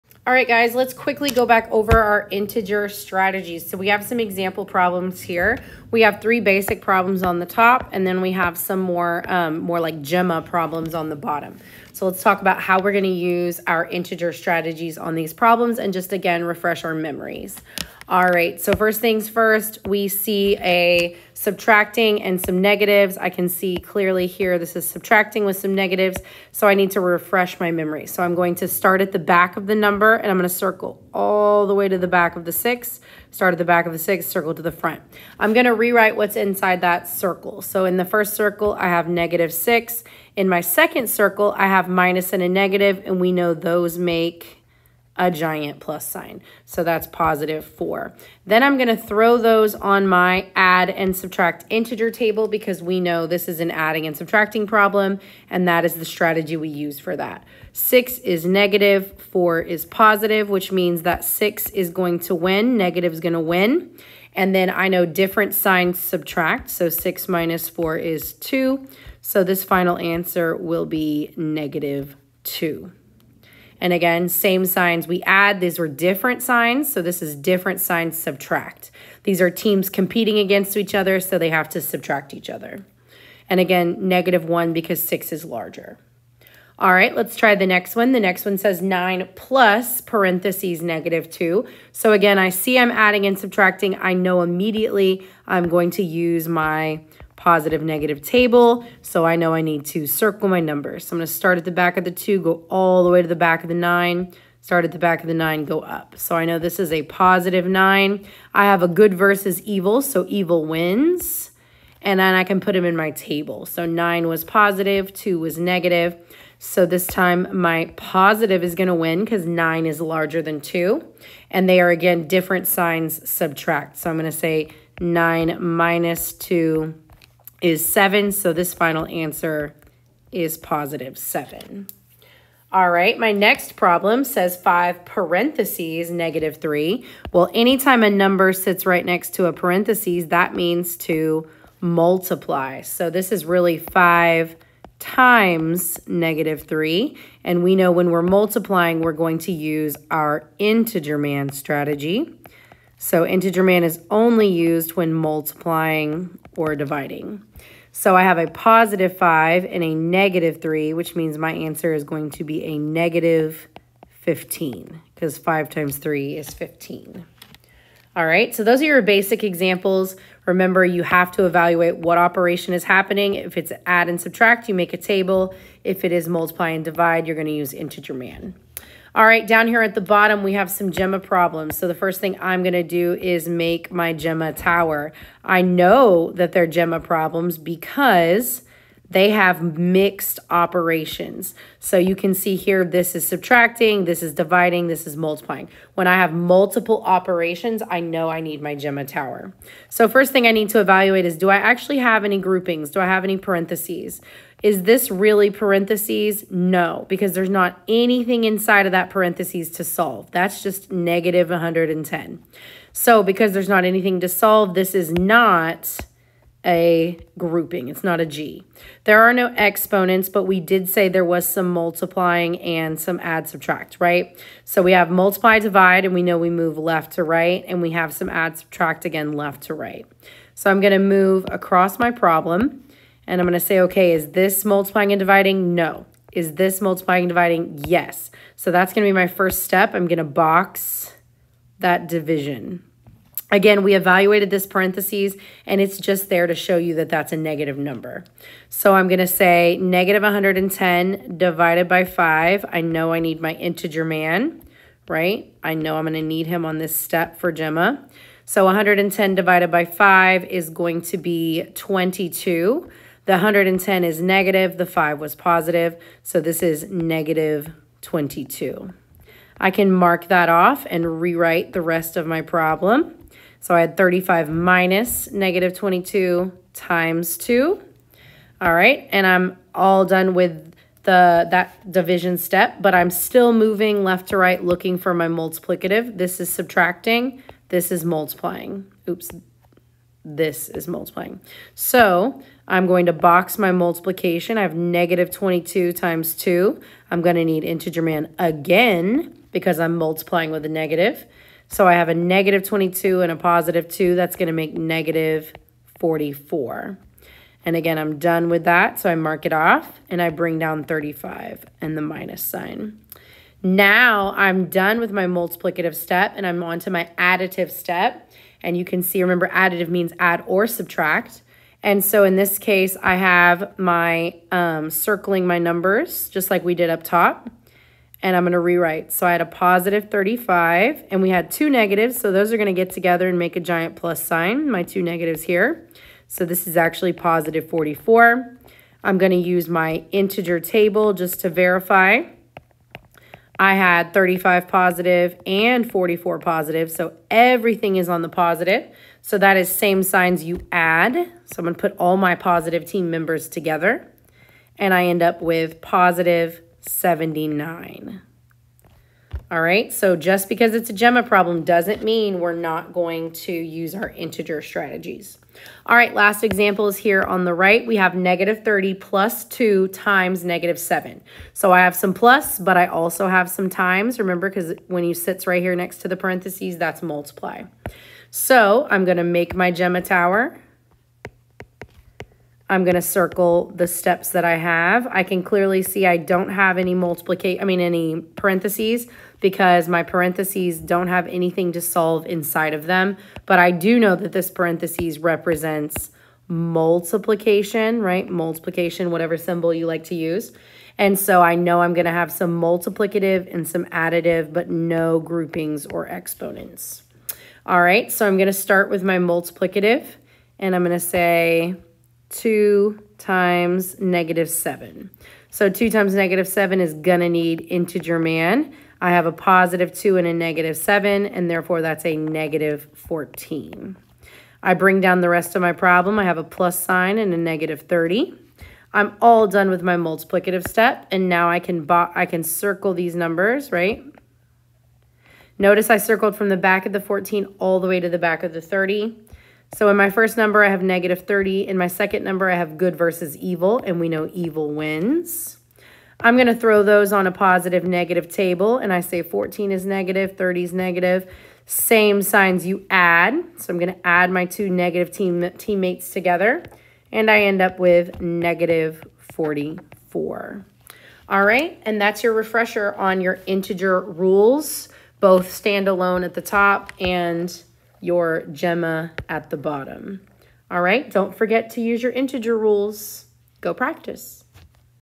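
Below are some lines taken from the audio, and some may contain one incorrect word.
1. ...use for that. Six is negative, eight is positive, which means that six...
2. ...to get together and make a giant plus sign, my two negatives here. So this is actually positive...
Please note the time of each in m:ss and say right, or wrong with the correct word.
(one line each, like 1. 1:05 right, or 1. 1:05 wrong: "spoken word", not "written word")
1. 0:56 wrong: "four", not "eight"
2. 5:32 right.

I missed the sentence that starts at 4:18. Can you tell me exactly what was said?
So 110 divided by five is going to be 22.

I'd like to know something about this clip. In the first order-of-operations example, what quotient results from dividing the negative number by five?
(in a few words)
-22.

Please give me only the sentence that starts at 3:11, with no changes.
So you can see here, this is subtracting, this is dividing, this is multiplying.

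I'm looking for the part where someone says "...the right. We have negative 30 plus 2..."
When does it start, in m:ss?
6:07.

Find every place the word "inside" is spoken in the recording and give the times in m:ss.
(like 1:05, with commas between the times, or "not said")
0:36, 3:28, 6:32.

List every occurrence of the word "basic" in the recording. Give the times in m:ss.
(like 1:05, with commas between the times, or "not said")
0:06, 2:49.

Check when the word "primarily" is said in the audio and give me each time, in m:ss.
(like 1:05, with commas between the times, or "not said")
not said.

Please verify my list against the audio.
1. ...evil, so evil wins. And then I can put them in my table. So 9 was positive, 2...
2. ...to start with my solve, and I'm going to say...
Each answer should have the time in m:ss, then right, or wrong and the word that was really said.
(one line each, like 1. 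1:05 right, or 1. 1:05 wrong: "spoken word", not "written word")
1. 1:49 right
2. 6:48 wrong: "multiplicative", not "solve".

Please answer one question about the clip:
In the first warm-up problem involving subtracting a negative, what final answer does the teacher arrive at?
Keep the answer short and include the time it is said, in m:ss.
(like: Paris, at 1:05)
-2, at 1:09.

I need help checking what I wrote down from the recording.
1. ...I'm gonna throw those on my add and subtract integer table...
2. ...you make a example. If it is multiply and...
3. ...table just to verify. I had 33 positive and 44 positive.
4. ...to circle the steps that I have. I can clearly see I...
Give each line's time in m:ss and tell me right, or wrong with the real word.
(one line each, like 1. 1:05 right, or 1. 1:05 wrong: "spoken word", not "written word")
1. 0:48 right
2. 2:54 wrong: "table", not "example"
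3. 5:40 wrong: "35", not "33"
4. 6:22 right.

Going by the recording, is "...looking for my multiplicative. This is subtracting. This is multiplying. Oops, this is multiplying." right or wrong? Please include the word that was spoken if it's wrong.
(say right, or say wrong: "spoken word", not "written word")
right.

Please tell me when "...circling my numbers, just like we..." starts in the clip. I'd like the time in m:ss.
5:24.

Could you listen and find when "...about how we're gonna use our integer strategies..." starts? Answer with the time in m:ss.
0:12.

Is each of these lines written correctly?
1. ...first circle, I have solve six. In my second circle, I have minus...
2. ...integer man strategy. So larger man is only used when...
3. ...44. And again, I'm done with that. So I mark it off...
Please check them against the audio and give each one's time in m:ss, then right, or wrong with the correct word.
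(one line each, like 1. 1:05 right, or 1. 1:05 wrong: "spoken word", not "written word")
1. 0:38 wrong: "negative", not "solve"
2. 2:30 wrong: "integer", not "larger"
3. 5:06 right.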